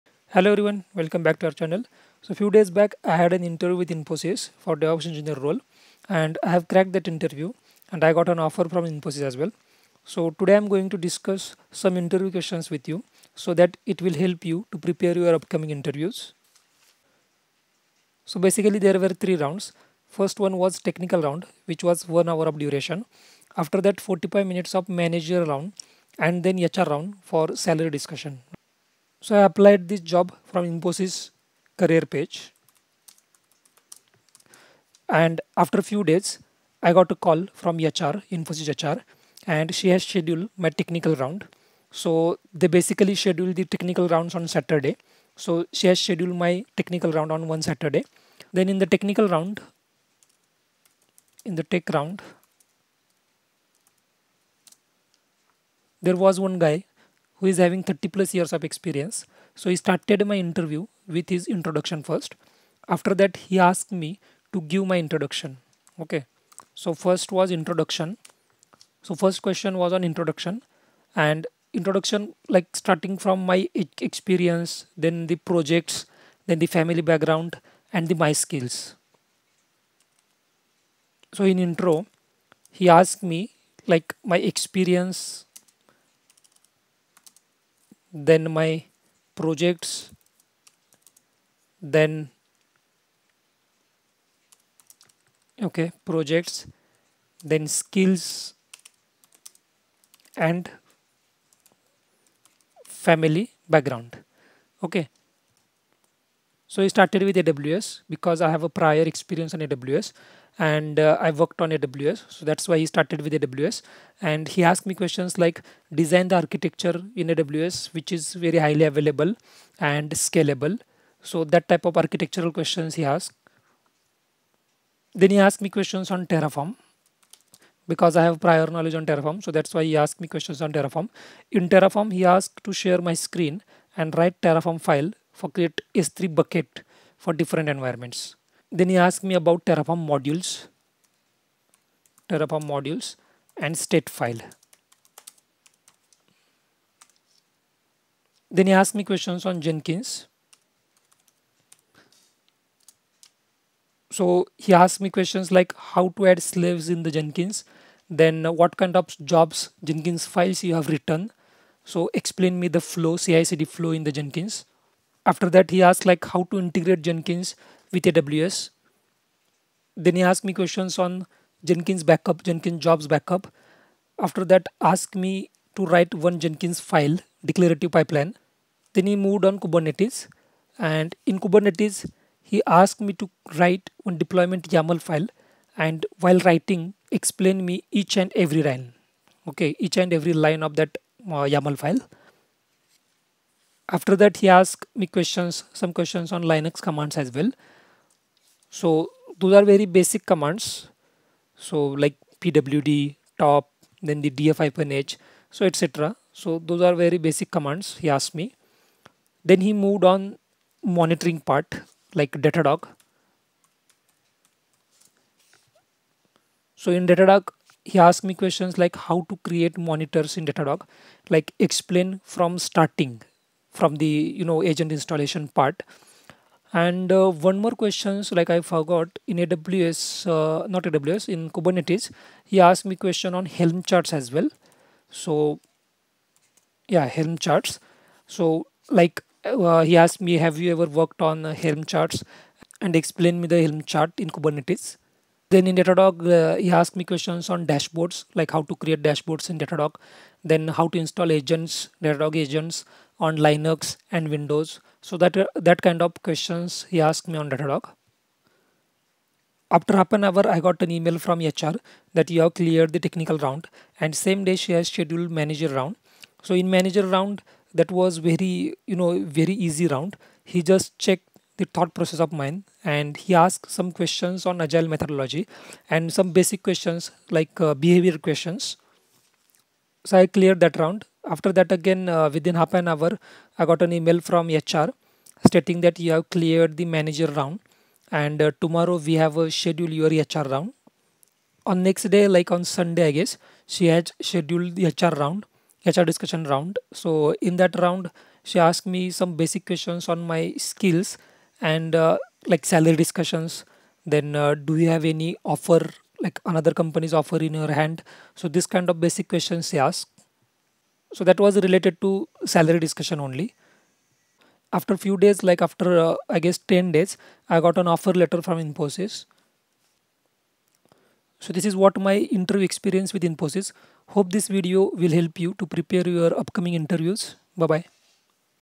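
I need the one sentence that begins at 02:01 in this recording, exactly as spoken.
So that type of architectural questions he asked.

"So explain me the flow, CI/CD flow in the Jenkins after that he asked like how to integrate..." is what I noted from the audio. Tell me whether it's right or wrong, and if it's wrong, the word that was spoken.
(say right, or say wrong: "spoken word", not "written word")
right.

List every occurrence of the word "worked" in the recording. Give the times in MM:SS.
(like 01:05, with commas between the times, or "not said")
01:51, 04:01.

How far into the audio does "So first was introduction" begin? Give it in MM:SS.
01:06.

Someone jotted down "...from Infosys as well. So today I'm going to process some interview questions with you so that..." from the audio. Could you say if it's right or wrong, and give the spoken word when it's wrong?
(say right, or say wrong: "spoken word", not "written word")
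wrong: "discuss", not "process".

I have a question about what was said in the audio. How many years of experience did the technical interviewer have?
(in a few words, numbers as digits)
30+.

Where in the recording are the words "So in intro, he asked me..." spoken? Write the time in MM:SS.
01:21.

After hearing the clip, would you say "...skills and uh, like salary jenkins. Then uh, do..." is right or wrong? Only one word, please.
wrong.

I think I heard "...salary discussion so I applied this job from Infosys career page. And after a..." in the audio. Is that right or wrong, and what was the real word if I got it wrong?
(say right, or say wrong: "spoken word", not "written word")
right.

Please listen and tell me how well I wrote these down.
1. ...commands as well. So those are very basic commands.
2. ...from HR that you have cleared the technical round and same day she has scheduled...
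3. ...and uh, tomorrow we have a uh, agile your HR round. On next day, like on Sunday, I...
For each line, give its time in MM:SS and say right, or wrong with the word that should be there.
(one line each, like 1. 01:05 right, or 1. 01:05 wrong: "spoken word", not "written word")
1. 03:16 right
2. 04:21 right
3. 04:48 wrong: "schedule", not "agile".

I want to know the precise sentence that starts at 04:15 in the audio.
So that uh, that kind of questions he asked me on Datadog.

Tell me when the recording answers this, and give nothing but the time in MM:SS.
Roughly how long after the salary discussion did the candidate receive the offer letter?
05:16.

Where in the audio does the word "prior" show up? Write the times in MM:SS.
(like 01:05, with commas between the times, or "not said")
01:48, 02:08.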